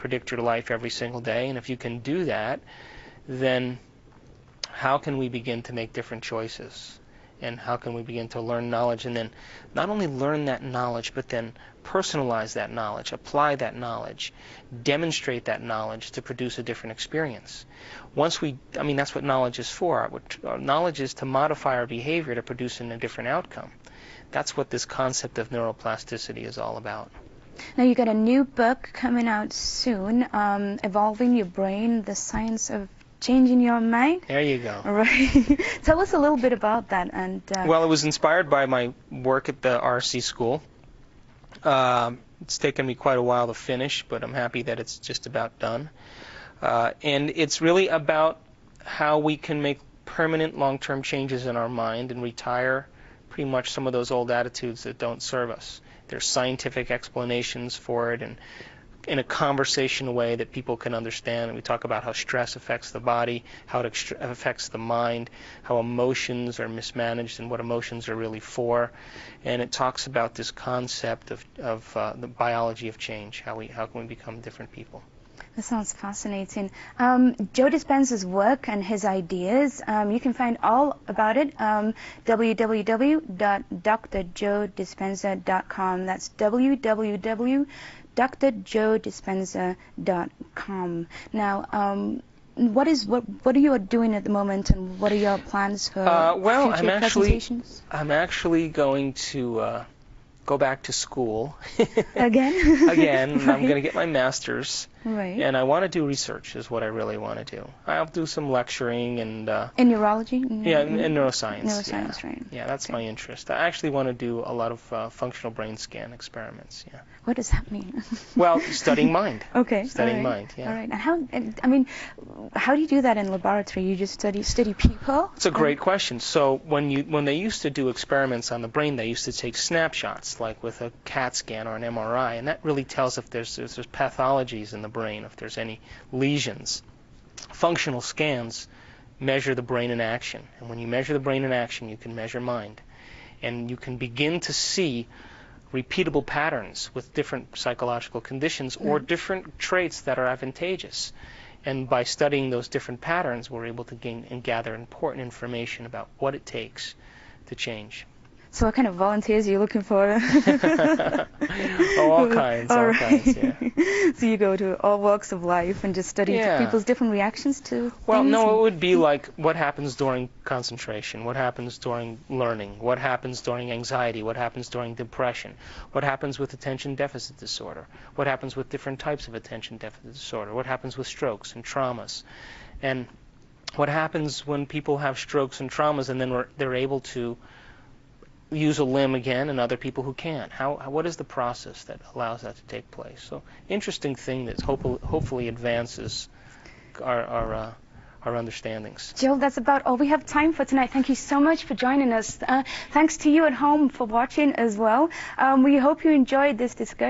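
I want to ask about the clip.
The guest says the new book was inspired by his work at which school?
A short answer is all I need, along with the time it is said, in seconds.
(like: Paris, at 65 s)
RC school, at 39 s.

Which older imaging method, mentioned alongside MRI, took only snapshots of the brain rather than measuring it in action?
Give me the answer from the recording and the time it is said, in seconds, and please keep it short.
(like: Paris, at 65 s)
CAT scan, at 131 s.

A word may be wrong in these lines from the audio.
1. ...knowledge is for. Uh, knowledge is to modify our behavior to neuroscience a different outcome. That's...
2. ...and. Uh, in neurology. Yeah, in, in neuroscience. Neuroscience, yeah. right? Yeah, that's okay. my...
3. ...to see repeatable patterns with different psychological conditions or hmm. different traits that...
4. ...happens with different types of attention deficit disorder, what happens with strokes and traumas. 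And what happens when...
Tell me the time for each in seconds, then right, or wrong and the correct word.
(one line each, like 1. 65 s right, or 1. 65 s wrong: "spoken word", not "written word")
1. 19 s wrong: "produce", not "neuroscience"
2. 109 s right
3. 144 s right
4. 178 s right.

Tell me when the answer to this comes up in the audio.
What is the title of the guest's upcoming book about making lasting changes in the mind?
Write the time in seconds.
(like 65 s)
30 s.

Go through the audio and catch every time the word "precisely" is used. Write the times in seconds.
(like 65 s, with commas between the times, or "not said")
not said.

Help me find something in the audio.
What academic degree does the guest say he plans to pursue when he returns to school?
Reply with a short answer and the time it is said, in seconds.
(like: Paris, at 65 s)
master's, at 104 s.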